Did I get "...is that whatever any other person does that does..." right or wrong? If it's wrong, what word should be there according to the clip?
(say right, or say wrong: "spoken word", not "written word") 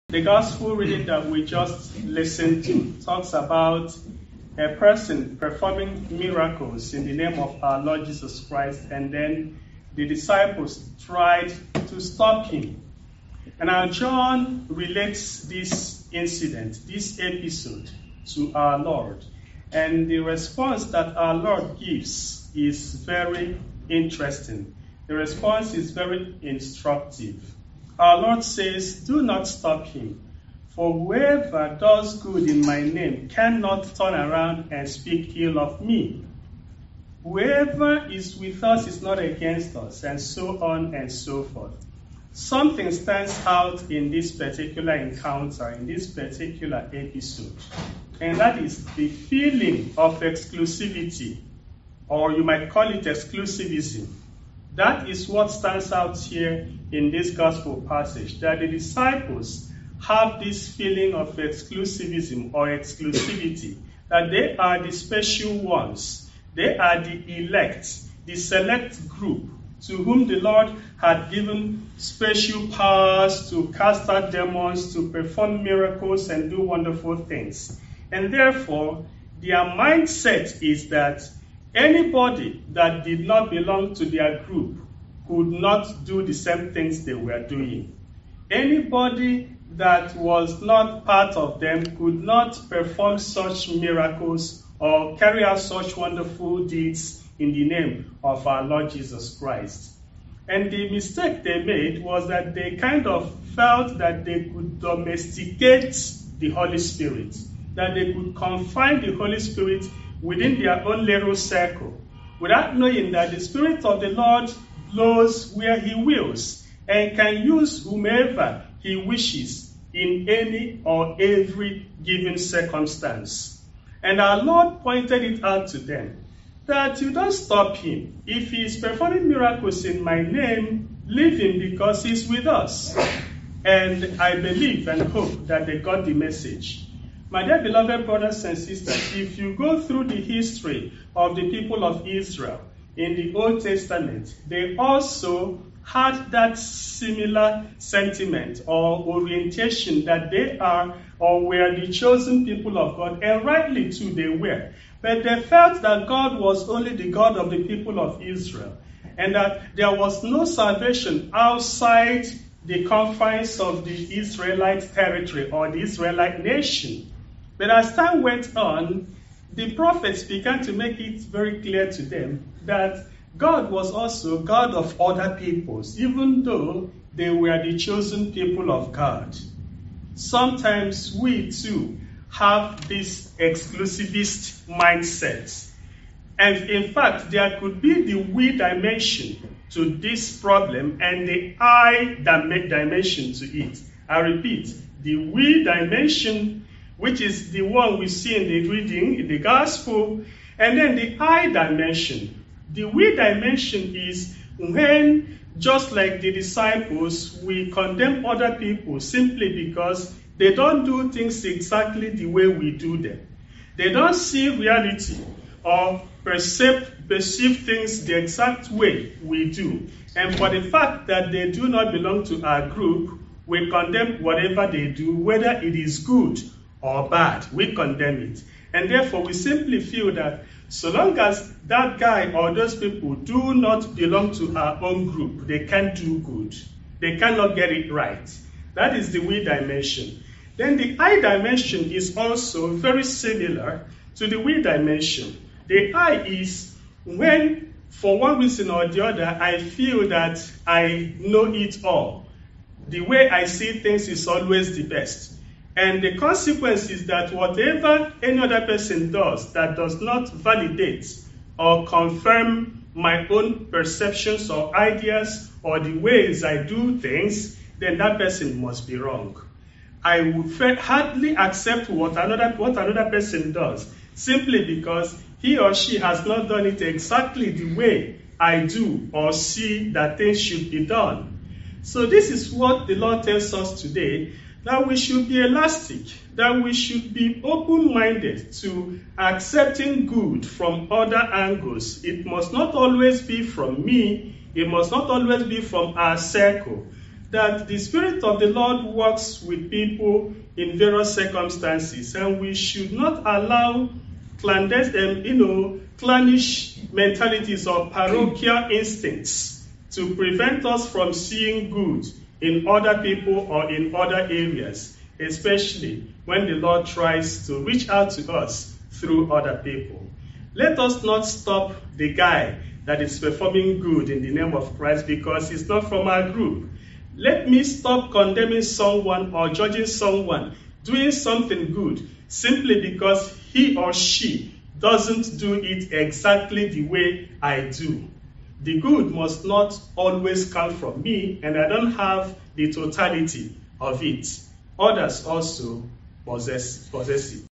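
right.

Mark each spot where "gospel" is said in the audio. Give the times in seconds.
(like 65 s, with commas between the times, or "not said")
0 s, 57 s, 199 s.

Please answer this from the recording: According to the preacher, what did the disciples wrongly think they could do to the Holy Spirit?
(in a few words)
domesticate.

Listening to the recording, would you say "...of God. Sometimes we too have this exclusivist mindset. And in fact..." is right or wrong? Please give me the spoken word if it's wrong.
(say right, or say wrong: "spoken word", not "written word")
right.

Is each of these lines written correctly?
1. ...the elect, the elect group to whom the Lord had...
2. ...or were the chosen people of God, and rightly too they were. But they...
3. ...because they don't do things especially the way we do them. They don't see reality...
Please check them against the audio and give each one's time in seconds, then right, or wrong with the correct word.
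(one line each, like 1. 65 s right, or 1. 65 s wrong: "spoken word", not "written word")
1. 67 s wrong: "select", not "elect"
2. 151 s right
3. 209 s wrong: "exactly", not "especially".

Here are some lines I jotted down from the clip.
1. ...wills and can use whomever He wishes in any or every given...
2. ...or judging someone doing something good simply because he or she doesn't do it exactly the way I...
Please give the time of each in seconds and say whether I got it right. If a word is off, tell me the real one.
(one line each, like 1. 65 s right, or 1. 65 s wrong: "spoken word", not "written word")
1. 115 s right
2. 329 s right.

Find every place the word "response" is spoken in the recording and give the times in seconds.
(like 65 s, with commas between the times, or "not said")
20 s, 25 s.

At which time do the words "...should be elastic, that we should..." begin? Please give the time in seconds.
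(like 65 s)
284 s.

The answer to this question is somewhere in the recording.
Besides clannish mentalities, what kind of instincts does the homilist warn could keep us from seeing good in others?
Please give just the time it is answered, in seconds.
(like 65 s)
307 s.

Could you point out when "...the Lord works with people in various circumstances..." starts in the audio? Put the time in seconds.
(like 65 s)
298 s.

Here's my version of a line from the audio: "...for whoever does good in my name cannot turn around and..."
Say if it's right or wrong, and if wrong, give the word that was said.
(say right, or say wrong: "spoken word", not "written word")
right.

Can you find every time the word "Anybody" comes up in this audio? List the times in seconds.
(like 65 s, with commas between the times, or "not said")
81 s, 88 s.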